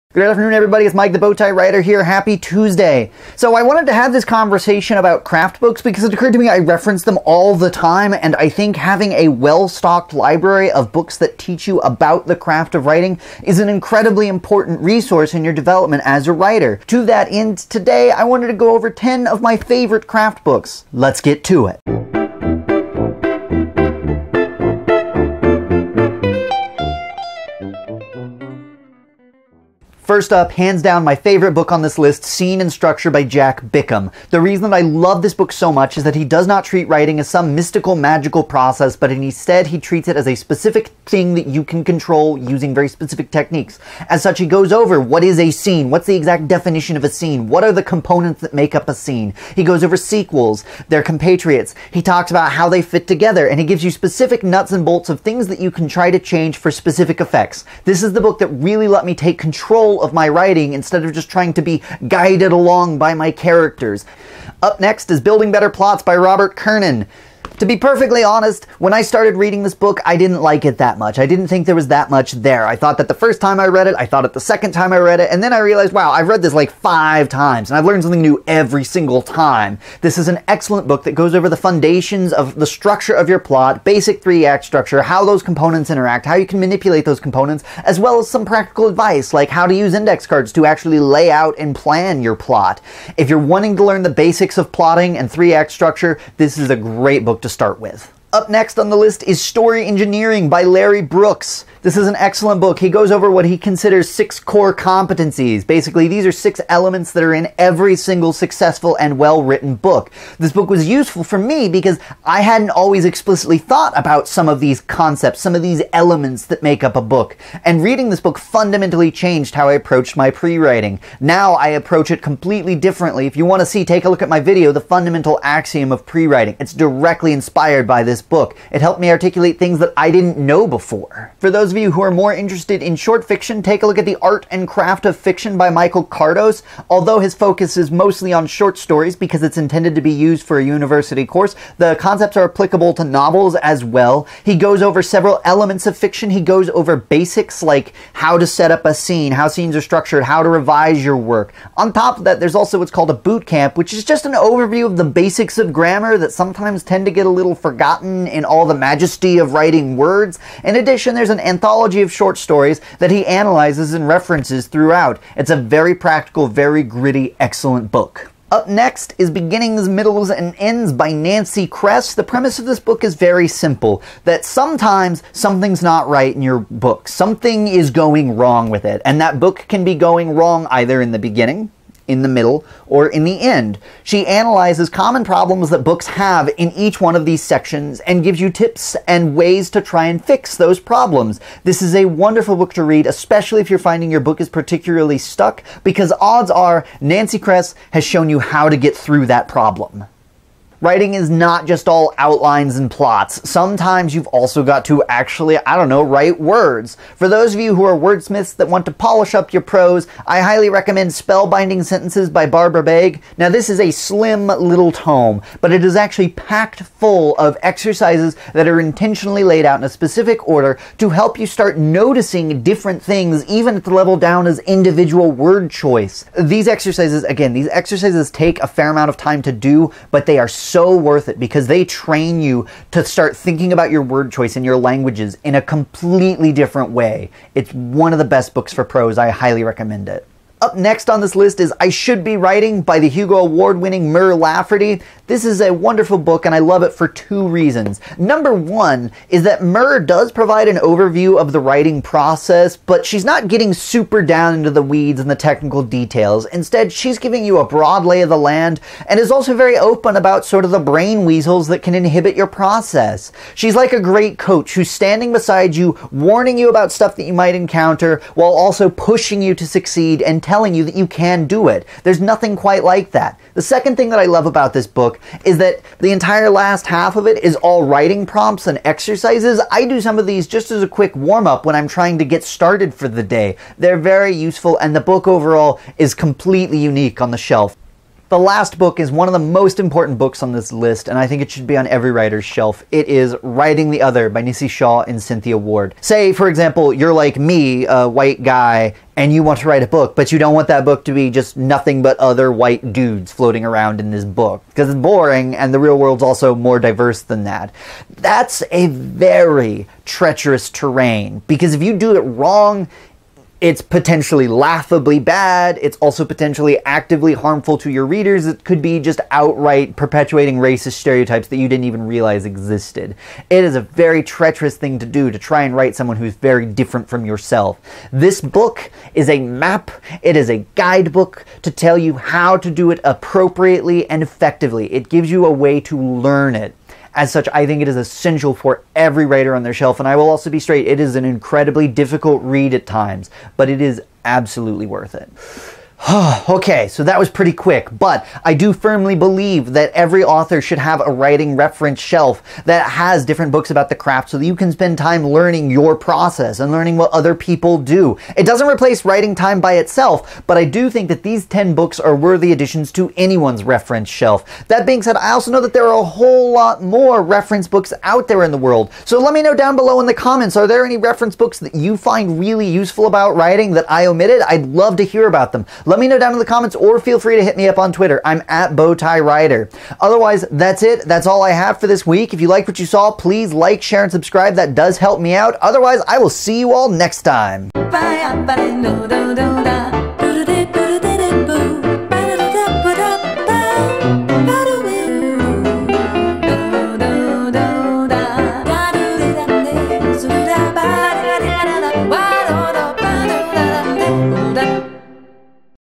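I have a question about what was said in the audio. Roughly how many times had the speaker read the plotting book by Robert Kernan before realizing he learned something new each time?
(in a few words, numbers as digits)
5.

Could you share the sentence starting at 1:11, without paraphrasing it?
I didn't think there was that much there.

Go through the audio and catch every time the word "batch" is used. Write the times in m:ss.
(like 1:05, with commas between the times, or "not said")
not said.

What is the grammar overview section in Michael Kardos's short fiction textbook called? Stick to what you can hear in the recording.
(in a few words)
boot camp.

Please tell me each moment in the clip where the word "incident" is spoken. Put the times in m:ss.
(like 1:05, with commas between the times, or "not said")
not said.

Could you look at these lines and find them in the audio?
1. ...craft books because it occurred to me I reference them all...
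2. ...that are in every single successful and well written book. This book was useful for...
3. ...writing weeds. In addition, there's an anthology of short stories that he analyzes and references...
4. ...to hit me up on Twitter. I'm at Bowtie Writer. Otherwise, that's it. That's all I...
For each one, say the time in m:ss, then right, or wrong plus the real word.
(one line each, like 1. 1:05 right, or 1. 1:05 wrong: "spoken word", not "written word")
1. 0:05 right
2. 1:47 right
3. 2:39 wrong: "words", not "weeds"
4. 6:17 right.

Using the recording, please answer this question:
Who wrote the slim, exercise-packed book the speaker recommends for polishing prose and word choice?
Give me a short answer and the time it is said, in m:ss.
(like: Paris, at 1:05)
Barbara Baig, at 3:32.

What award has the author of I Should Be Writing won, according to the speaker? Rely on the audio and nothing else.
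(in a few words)
Hugo Award.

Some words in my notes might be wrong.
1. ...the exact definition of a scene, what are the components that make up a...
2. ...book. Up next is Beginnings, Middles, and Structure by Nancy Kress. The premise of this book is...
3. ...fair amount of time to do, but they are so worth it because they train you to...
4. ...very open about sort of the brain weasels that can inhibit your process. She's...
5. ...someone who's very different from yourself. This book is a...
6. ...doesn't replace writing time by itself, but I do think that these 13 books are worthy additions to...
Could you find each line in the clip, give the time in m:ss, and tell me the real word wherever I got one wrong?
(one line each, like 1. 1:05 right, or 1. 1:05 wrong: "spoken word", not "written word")
1. 0:46 right
2. 2:47 wrong: "Ends", not "Structure"
3. 3:48 right
4. 4:19 right
5. 5:25 right
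6. 5:58 wrong: "10", not "13".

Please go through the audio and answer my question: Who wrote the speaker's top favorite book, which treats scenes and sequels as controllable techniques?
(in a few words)
Jack Bickham.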